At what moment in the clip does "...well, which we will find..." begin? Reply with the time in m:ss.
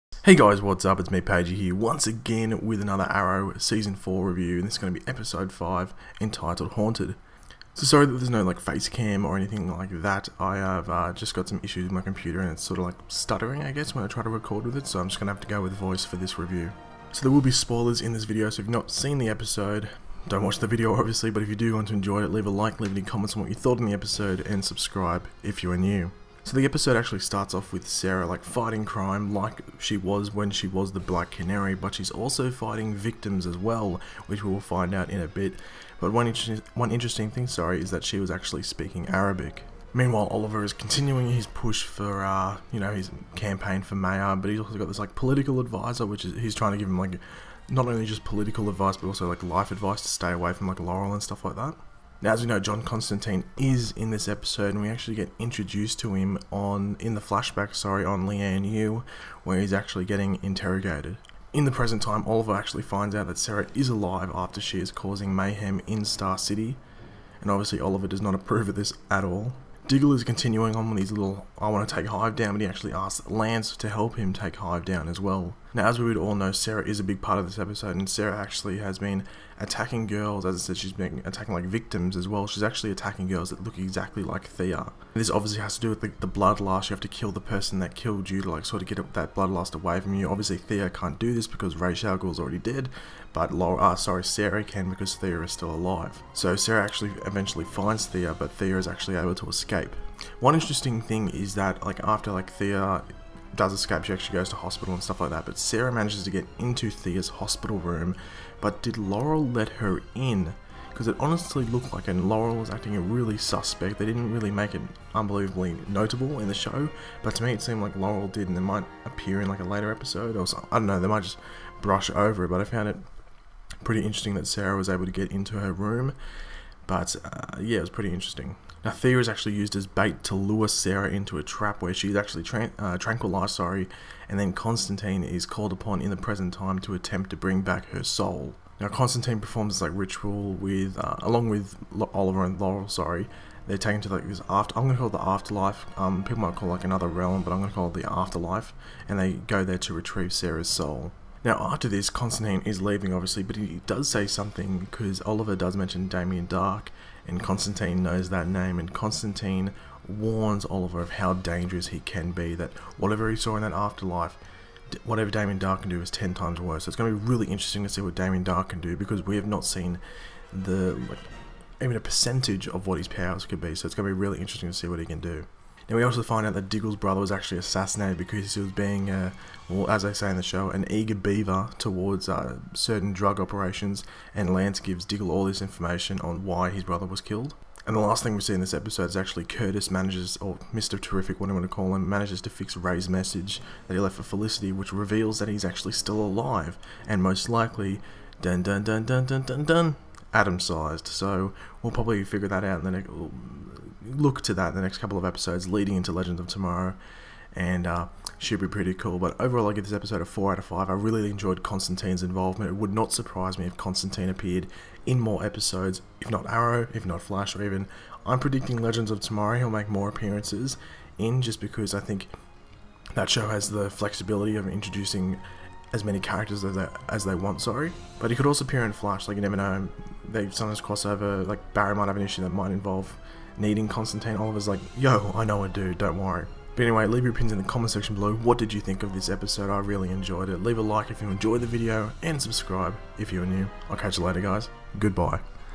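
0:33.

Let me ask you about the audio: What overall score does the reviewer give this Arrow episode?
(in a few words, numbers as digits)
4 out of 5.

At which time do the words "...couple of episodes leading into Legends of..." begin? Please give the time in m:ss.
3:24.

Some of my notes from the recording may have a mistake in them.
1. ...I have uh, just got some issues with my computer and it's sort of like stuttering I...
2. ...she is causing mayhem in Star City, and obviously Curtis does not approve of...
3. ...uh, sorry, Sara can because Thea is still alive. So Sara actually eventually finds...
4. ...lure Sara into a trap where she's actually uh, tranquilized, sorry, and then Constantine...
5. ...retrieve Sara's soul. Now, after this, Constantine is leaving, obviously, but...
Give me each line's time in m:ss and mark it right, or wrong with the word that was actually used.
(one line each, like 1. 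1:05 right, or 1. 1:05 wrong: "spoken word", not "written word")
1. 0:10 right
2. 1:04 wrong: "Oliver", not "Curtis"
3. 1:33 right
4. 2:10 right
5. 2:29 right.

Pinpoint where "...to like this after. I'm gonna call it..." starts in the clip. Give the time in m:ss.
2:24.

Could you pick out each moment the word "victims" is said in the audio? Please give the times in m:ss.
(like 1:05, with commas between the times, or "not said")
0:32, 1:21.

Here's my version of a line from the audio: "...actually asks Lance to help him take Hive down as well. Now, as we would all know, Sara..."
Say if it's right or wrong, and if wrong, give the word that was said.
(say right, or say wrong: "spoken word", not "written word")
right.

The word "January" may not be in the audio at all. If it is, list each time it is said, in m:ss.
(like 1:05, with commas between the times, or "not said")
not said.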